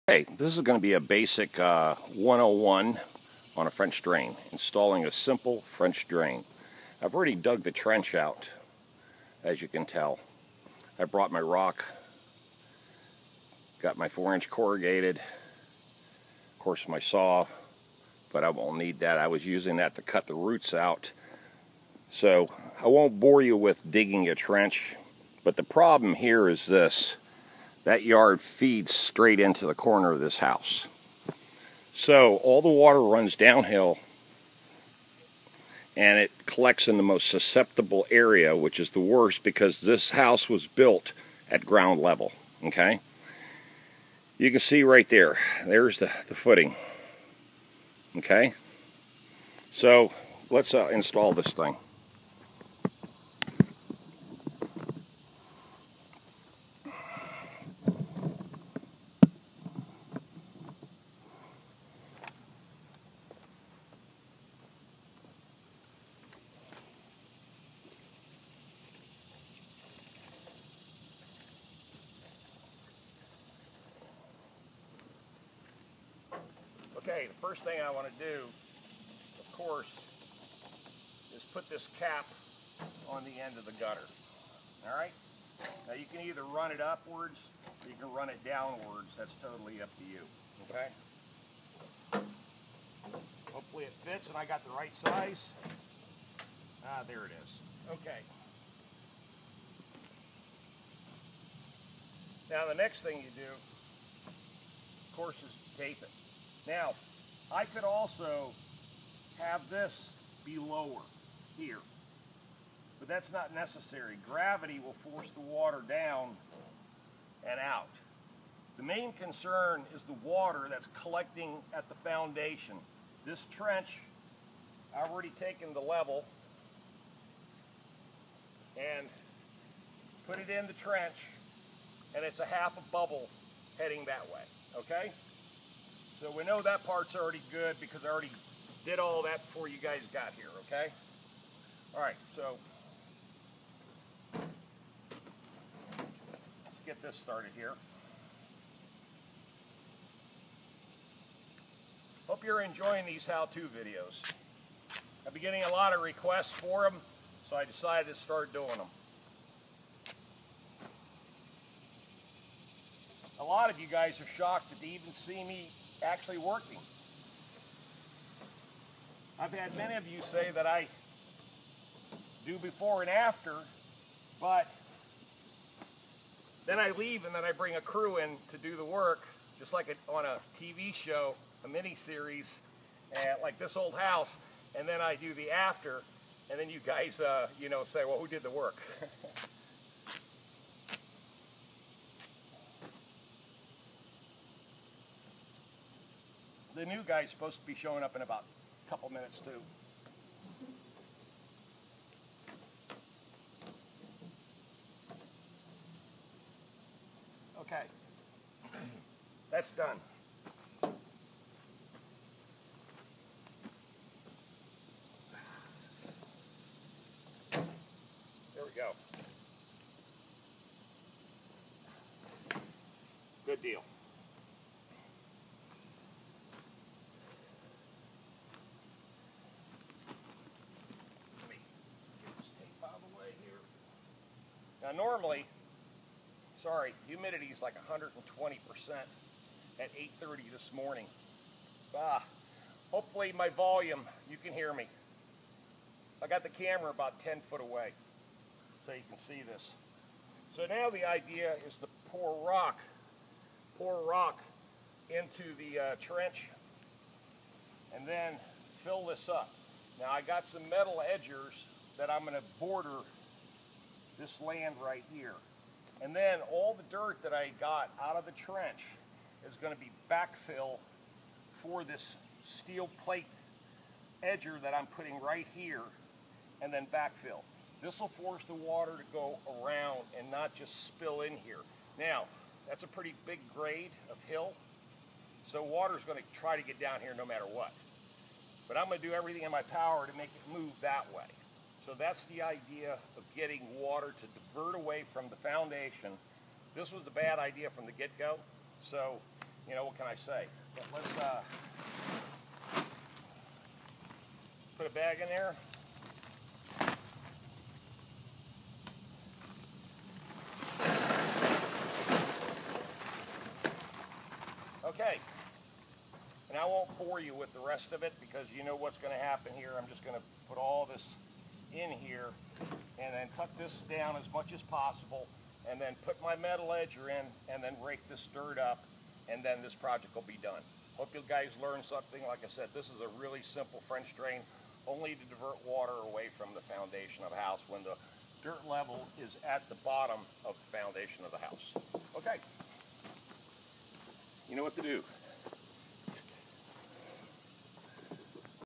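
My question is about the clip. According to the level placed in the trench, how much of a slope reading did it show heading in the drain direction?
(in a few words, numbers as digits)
half a bubble.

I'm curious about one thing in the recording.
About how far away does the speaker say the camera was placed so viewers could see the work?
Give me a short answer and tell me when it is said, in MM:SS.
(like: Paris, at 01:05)
10 feet, at 04:07.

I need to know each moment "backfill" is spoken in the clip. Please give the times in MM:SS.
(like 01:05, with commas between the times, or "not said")
04:30, 04:36.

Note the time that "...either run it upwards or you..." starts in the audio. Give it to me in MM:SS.
01:26.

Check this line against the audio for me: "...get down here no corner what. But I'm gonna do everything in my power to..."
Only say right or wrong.
wrong.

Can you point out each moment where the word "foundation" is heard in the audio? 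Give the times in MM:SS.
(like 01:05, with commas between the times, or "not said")
02:02, 04:55, 05:36, 05:40.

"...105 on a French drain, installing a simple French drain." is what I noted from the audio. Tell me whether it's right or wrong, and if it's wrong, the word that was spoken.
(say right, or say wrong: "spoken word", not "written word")
wrong: "101", not "105".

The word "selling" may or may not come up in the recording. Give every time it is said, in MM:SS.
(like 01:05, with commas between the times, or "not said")
not said.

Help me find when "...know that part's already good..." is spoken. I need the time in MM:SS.
02:16.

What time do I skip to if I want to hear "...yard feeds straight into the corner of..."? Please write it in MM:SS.
00:28.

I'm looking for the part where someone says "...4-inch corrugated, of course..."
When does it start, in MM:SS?
00:14.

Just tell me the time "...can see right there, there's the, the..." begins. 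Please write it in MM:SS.
00:44.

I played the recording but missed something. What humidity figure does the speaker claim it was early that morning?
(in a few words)
120%.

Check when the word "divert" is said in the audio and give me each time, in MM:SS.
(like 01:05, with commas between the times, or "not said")
04:54, 05:35.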